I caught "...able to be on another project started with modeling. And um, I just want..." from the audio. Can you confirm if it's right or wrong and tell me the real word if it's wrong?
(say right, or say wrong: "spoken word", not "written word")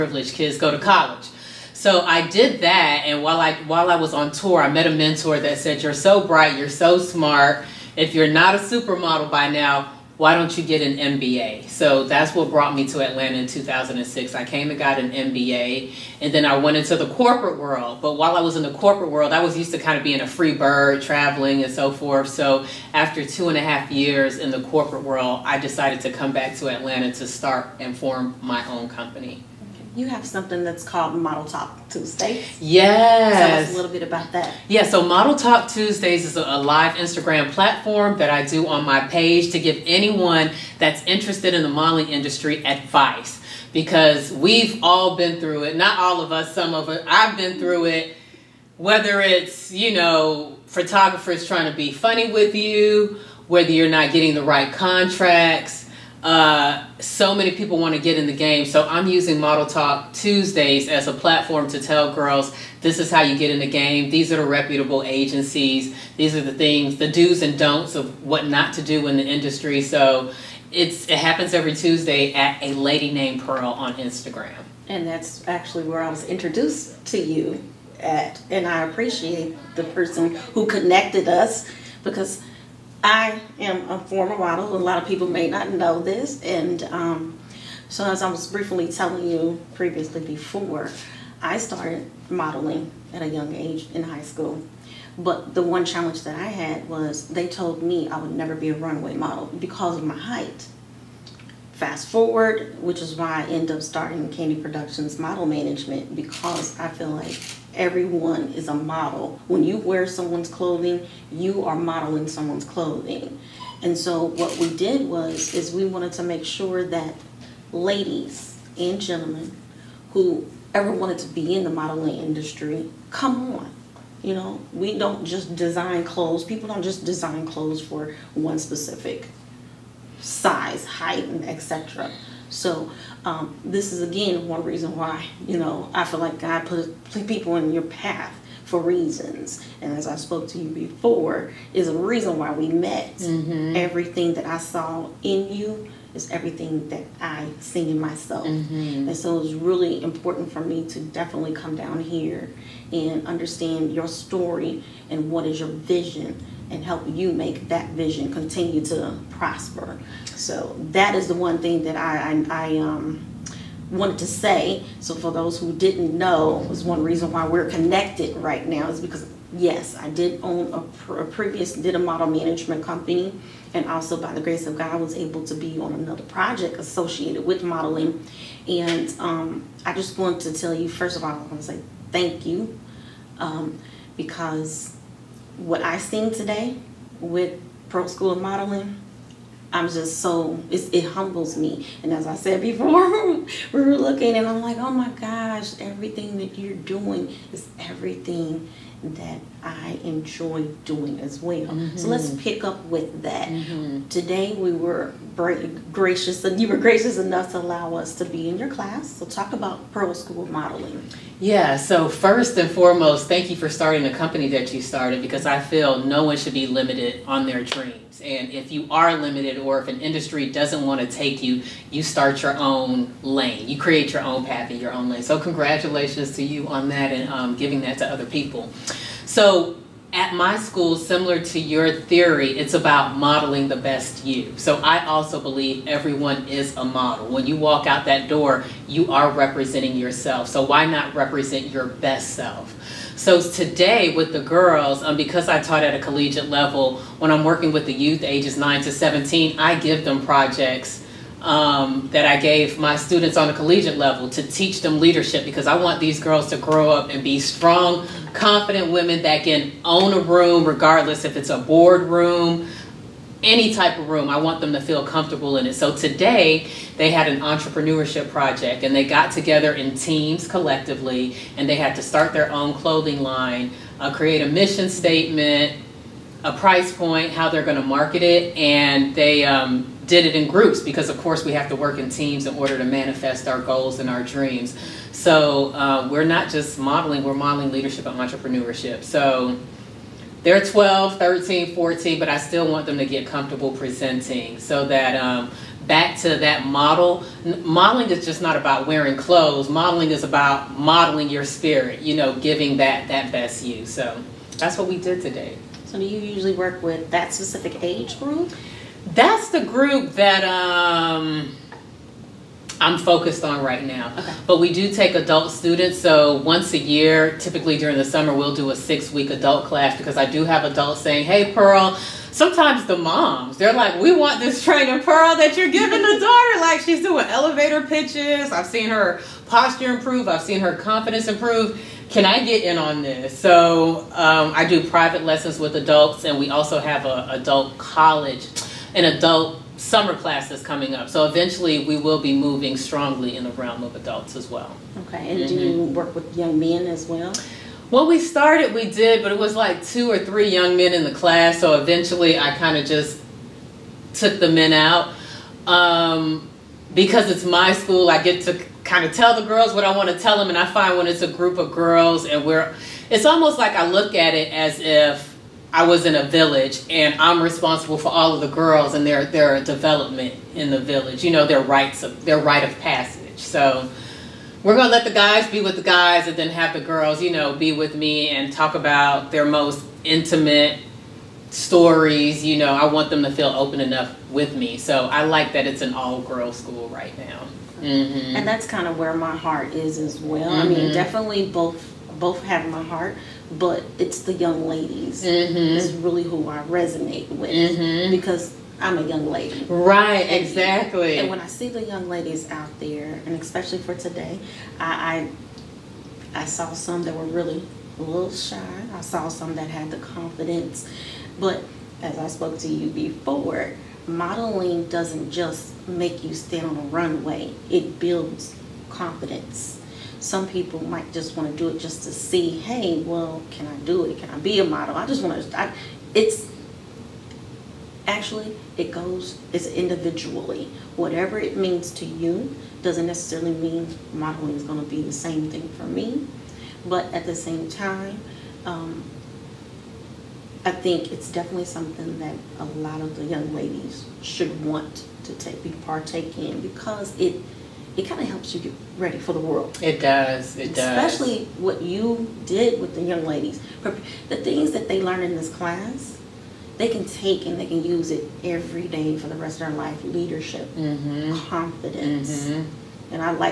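wrong: "associated", not "started".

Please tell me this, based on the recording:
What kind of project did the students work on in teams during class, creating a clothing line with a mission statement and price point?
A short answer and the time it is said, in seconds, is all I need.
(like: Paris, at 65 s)
Entrepreneurship project, at 267 s.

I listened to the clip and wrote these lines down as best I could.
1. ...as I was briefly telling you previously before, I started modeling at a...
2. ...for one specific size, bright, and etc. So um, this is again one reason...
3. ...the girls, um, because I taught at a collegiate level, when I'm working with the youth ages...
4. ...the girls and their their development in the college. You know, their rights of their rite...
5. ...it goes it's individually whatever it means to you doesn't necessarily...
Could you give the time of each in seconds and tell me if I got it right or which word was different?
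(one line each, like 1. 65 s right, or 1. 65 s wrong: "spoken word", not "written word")
1. 88 s right
2. 127 s wrong: "height", not "bright"
3. 244 s right
4. 368 s wrong: "village", not "college"
5. 428 s right.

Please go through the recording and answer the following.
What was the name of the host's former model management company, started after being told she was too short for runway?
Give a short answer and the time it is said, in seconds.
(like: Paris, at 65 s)
Candy Productions, at 104 s.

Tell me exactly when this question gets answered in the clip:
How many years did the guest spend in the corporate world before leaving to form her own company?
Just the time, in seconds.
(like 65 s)
23 s.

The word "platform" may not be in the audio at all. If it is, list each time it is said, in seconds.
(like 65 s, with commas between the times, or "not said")
37 s, 61 s.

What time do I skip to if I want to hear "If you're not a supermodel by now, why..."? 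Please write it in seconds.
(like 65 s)
7 s.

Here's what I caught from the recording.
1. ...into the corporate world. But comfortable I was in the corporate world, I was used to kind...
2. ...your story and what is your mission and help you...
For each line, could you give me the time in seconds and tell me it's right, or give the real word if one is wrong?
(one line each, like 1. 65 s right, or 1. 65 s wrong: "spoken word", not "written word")
1. 16 s wrong: "while", not "comfortable"
2. 153 s wrong: "vision", not "mission".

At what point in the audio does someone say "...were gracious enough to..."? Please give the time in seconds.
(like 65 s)
206 s.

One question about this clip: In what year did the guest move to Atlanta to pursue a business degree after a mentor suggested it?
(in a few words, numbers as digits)
2006.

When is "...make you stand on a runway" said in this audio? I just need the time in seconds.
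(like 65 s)
415 s.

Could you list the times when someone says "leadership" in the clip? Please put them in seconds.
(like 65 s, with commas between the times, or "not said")
254 s, 287 s, 460 s.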